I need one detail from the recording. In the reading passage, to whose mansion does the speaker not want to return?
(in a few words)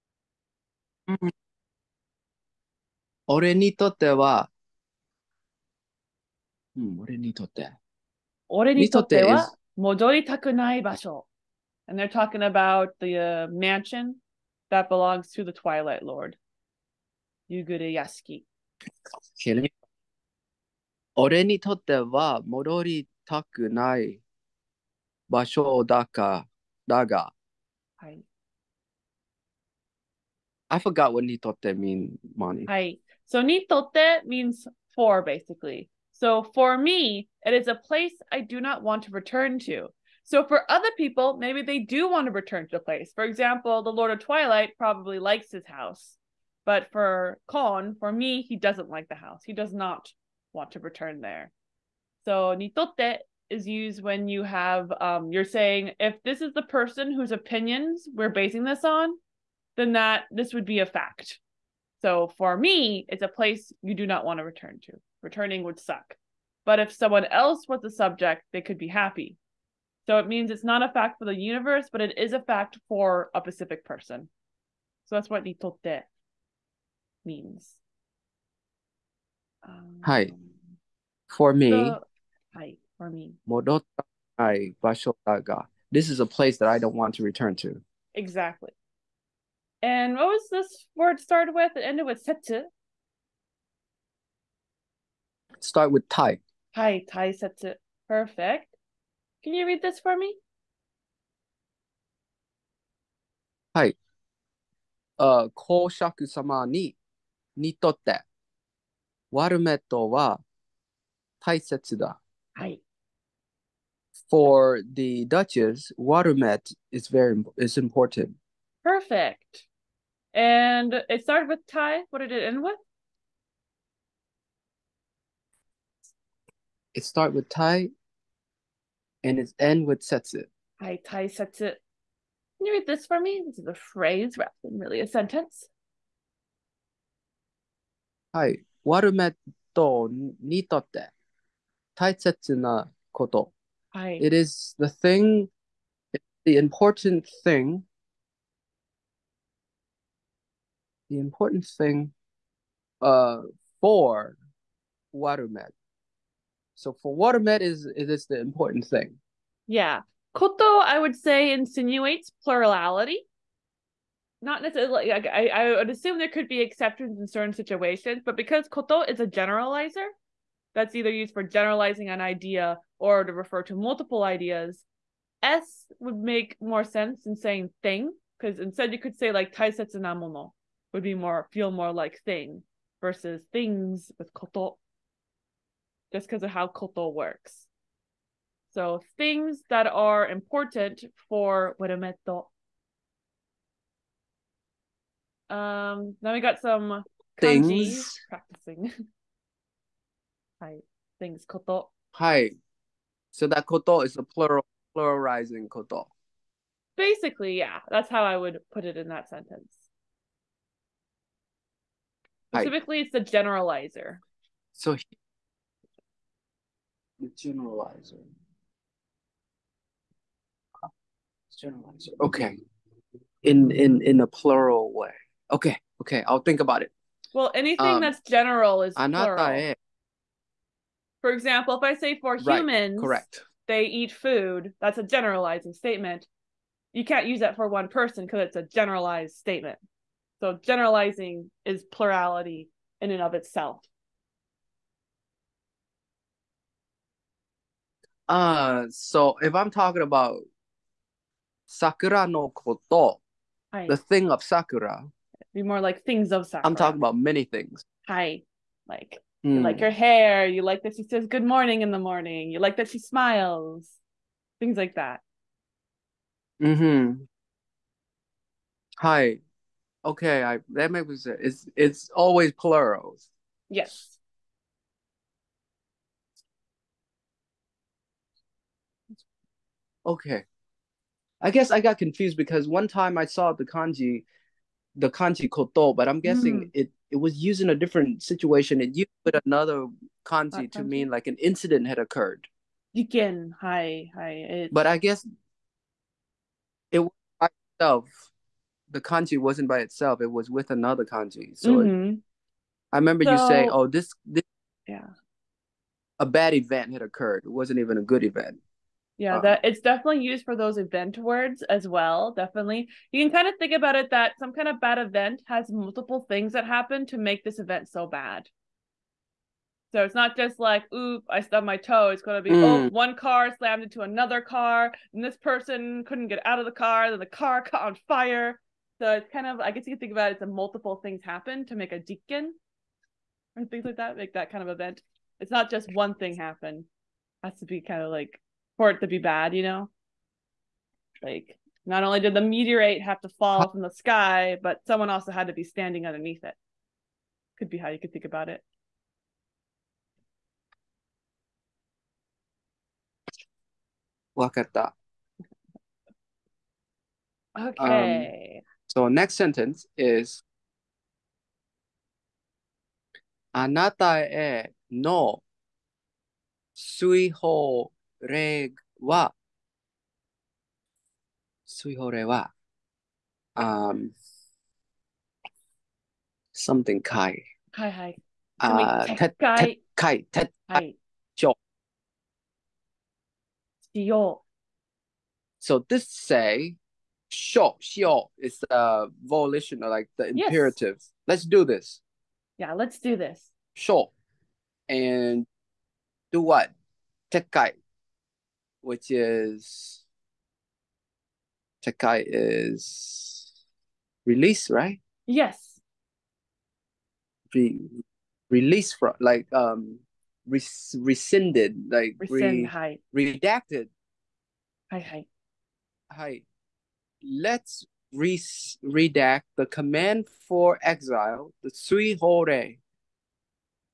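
Twilight Lord.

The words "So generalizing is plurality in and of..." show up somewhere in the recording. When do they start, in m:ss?
4:00.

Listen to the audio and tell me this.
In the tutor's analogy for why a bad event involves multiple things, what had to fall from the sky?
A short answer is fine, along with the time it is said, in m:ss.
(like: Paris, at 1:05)
meteorite, at 5:42.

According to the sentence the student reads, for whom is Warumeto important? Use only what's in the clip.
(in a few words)
the Duchess.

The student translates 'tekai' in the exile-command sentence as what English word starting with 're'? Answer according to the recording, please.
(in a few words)
redact.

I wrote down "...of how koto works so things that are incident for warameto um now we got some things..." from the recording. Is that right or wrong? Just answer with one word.
wrong.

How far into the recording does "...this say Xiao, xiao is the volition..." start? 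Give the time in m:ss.
6:25.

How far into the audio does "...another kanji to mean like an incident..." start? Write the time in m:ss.
4:49.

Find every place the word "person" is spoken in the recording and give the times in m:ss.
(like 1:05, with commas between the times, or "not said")
0:56, 1:13, 3:57, 5:25.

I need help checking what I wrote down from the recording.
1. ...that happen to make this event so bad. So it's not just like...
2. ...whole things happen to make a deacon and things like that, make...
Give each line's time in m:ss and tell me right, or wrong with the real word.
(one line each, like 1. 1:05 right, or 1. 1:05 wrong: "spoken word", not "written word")
1. 5:16 right
2. 5:30 wrong: "multiple", not "whole".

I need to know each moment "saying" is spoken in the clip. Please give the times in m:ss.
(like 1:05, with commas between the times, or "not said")
0:55, 2:57.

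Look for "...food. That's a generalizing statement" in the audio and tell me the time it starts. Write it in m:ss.
3:54.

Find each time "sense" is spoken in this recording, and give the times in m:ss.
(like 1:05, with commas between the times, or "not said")
2:56, 4:31.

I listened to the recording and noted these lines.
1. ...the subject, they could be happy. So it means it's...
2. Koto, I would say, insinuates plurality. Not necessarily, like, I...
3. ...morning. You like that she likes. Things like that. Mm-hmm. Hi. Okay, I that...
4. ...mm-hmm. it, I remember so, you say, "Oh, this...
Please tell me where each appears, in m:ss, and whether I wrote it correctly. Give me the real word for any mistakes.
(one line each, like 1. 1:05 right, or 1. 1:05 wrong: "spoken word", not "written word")
1. 1:07 right
2. 2:40 right
3. 4:22 wrong: "smiles", not "likes"
4. 5:01 right.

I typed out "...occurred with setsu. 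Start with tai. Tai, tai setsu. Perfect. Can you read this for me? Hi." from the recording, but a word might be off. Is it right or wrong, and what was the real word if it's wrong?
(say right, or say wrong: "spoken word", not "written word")
wrong: "ended", not "occurred".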